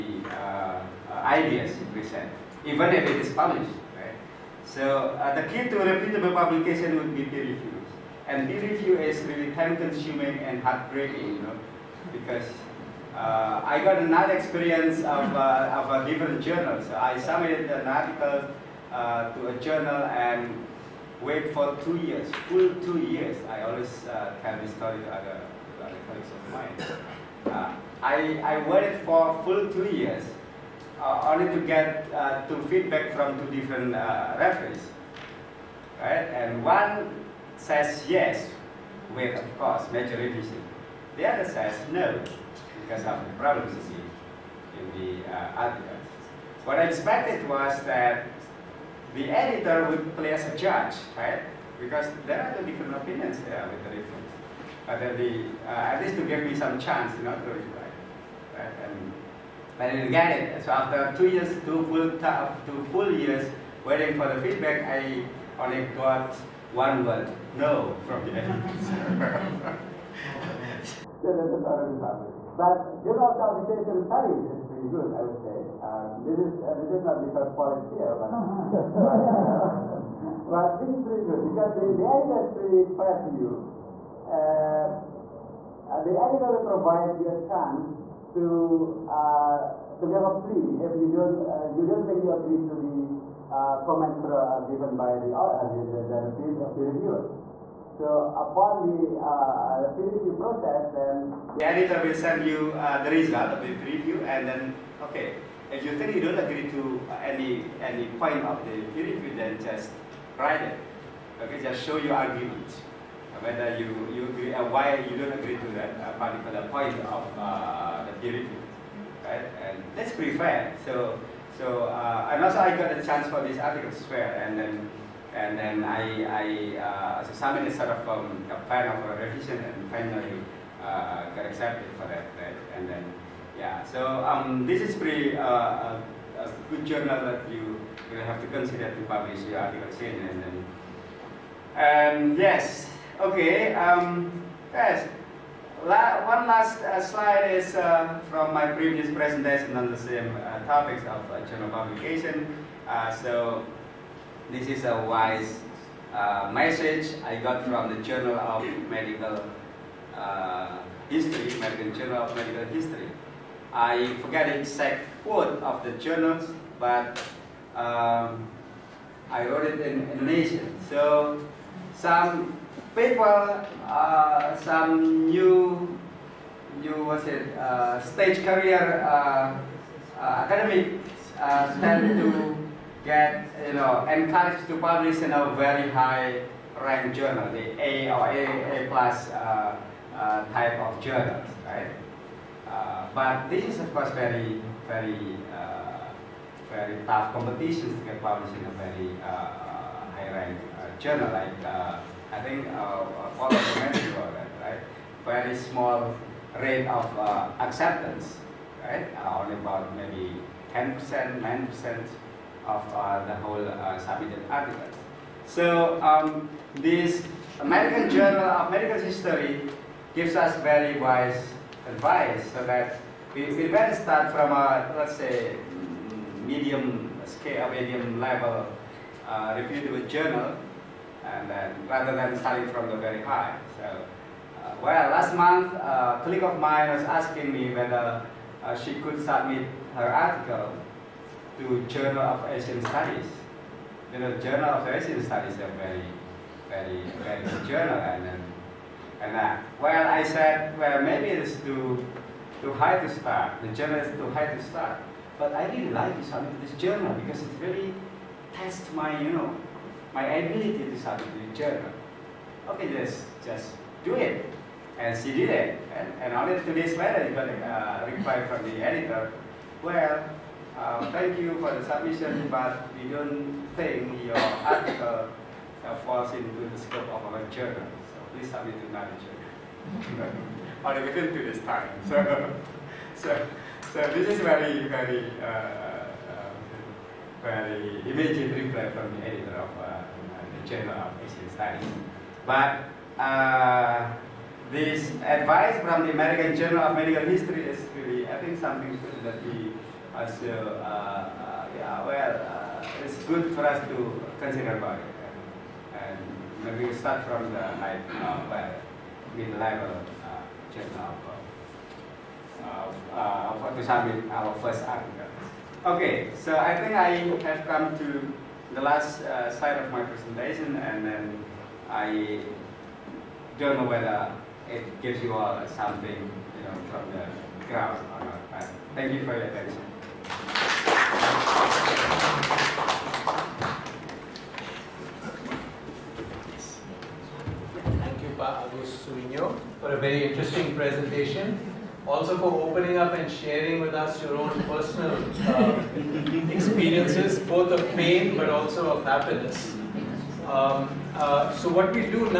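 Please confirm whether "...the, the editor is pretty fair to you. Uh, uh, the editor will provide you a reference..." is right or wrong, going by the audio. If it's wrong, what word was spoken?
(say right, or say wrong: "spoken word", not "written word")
wrong: "chance", not "reference".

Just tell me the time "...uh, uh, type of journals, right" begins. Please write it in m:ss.
3:09.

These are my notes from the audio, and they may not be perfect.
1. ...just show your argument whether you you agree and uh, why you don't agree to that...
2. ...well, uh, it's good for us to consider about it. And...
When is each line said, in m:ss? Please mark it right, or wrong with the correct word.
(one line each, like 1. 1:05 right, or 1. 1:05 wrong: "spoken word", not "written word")
1. 1:51 right
2. 5:02 right.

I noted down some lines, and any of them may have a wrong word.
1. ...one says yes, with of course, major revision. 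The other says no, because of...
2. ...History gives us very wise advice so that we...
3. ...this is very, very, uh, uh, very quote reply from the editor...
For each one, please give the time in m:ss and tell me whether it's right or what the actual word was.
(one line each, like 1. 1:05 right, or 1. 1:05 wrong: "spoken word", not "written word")
1. 0:36 right
2. 3:39 right
3. 4:44 wrong: "immediate", not "quote".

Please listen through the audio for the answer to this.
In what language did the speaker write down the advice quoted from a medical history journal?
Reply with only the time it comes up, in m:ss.
2:50.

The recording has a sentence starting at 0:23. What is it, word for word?
I always uh, tell this story to other, to other colleagues of mine.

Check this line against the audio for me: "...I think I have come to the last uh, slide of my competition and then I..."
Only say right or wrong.
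wrong.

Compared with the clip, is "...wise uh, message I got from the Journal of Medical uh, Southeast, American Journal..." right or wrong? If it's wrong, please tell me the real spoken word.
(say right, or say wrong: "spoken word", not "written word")
wrong: "History", not "Southeast".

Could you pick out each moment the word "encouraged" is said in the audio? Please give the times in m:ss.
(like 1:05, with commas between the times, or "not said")
3:04.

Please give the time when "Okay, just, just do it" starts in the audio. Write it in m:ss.
4:22.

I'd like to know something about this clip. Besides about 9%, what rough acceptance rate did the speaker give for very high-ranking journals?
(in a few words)
10%.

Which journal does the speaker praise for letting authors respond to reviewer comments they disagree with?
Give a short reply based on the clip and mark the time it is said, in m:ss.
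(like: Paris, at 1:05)
Journal of Southeast Asian Studies, at 1:13.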